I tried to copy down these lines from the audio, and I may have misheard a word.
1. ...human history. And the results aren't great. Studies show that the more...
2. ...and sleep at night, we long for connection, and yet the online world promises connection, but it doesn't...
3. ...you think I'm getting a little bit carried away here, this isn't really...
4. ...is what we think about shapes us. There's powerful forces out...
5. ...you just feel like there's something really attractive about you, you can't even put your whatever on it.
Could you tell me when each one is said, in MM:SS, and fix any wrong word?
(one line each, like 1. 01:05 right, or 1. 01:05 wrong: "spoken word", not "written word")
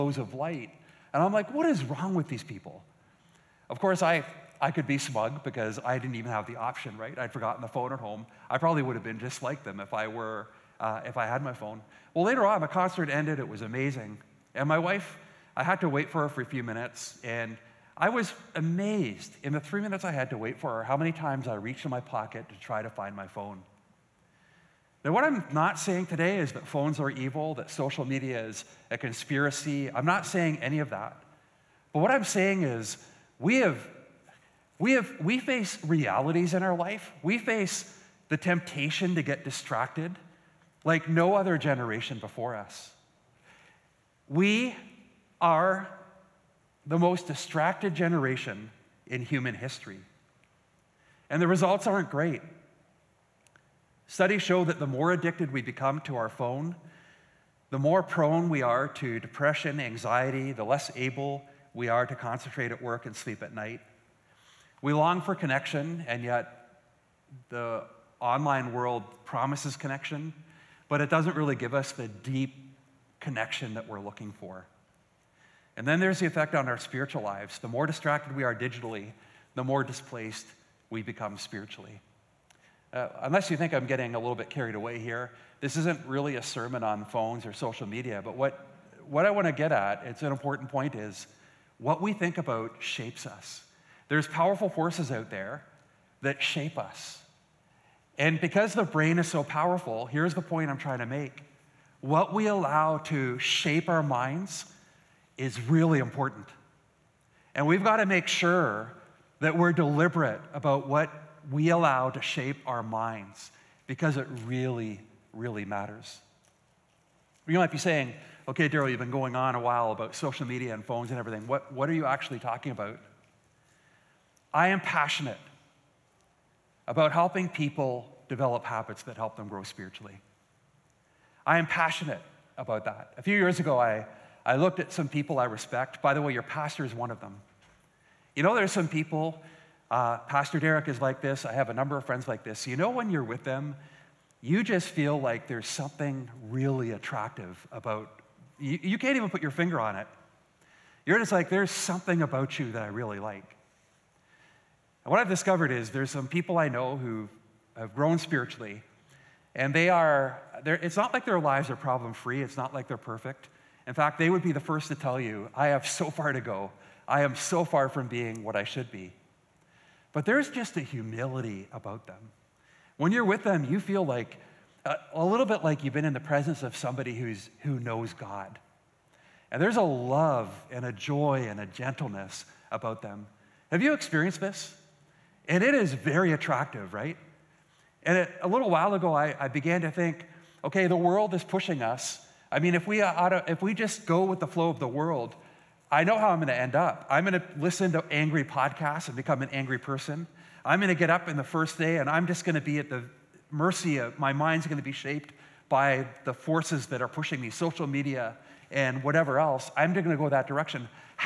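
1. 00:49 right
2. 01:03 right
3. 01:23 right
4. 01:30 right
5. 02:24 wrong: "finger", not "whatever".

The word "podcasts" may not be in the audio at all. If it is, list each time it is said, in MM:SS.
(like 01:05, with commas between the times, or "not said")
03:18.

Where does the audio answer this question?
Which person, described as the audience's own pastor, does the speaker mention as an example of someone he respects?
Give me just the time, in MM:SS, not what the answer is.
02:20.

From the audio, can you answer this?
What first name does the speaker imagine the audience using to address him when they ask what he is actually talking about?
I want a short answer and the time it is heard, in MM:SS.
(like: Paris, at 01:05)
Darryl, at 01:58.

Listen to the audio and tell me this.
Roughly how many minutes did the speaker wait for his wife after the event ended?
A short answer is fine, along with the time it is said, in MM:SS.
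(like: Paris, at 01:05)
3 minutes, at 00:19.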